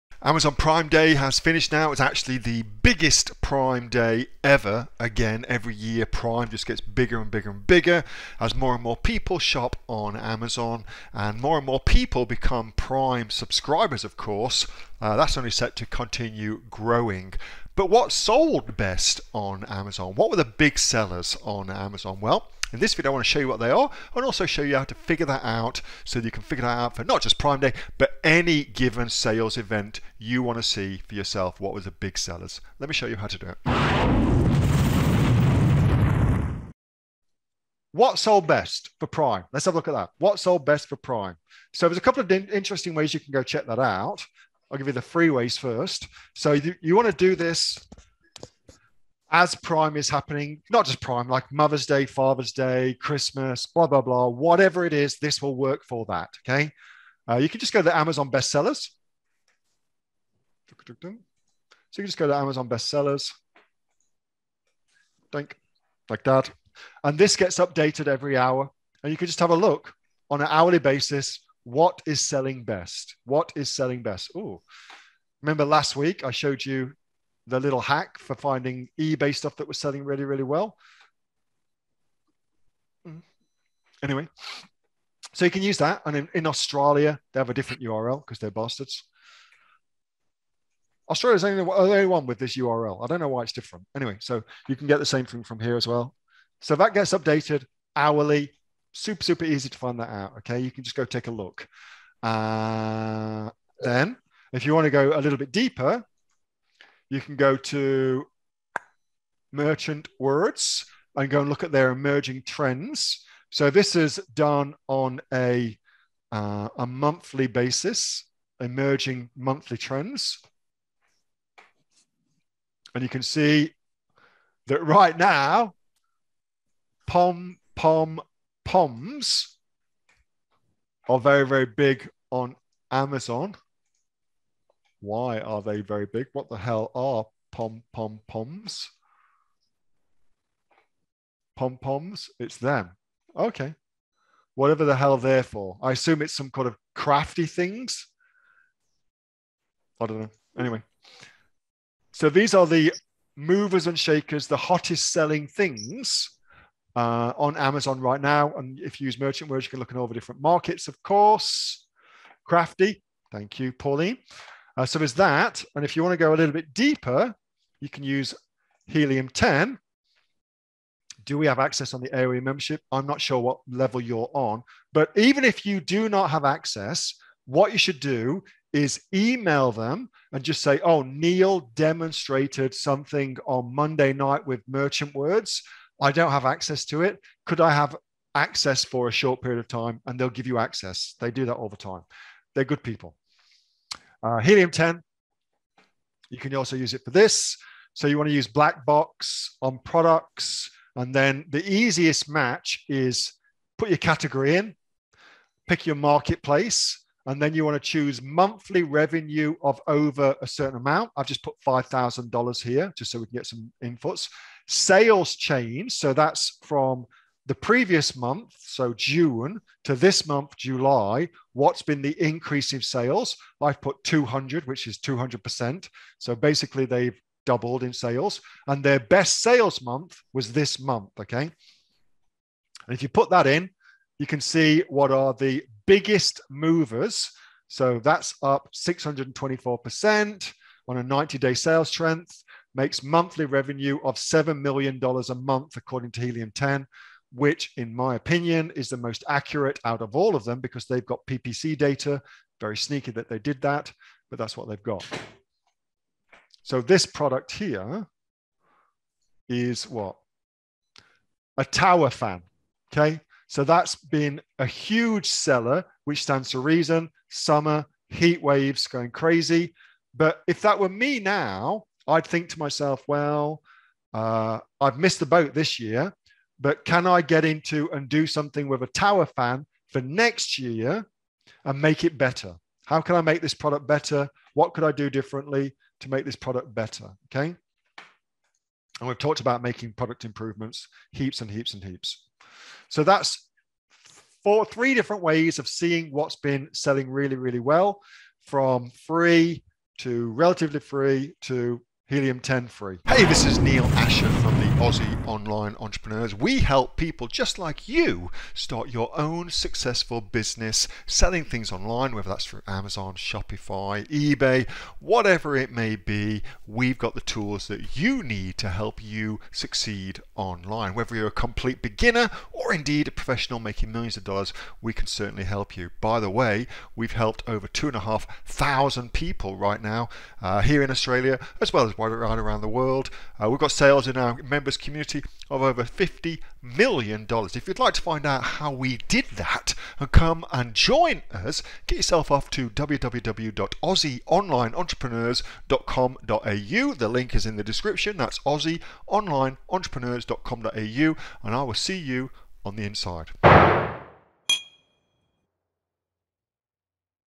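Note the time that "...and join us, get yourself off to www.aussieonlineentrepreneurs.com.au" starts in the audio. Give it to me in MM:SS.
05:40.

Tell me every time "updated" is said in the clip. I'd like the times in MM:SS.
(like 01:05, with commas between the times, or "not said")
01:07, 01:37.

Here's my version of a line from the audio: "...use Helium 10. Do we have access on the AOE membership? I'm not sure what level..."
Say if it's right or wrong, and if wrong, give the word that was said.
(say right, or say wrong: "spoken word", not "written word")
right.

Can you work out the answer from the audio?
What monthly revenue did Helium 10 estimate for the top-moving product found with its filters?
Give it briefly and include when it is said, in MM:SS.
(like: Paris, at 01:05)
$7 million, at 04:04.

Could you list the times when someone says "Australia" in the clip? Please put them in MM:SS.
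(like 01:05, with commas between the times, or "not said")
01:26, 01:31, 05:30.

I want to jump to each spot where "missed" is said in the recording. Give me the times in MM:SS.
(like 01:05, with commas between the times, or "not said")
04:34.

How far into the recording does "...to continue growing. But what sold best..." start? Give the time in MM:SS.
00:15.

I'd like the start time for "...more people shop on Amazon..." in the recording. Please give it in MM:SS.
00:08.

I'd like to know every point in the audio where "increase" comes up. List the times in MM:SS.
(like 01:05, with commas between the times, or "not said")
03:42.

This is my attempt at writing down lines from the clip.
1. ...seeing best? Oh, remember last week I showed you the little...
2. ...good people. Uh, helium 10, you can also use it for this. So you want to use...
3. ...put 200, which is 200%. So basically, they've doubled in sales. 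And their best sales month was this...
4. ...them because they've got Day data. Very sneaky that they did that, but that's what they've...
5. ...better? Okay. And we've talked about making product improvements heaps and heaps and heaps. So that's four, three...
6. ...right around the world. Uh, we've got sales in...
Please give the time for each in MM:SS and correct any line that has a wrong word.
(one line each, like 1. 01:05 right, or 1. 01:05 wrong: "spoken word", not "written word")
1. 01:13 wrong: "selling", not "seeing"
2. 03:12 right
3. 03:43 right
4. 04:10 wrong: "PPC", not "Day"
5. 04:46 right
6. 05:32 right.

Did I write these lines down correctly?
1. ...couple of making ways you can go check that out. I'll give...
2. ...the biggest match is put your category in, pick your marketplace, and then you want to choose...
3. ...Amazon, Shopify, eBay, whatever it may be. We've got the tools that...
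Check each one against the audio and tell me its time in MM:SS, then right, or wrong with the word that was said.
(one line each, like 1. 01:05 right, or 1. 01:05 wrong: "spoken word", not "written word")
1. 00:42 wrong: "interesting", not "making"
2. 03:21 wrong: "easiest", not "biggest"
3. 05:12 right.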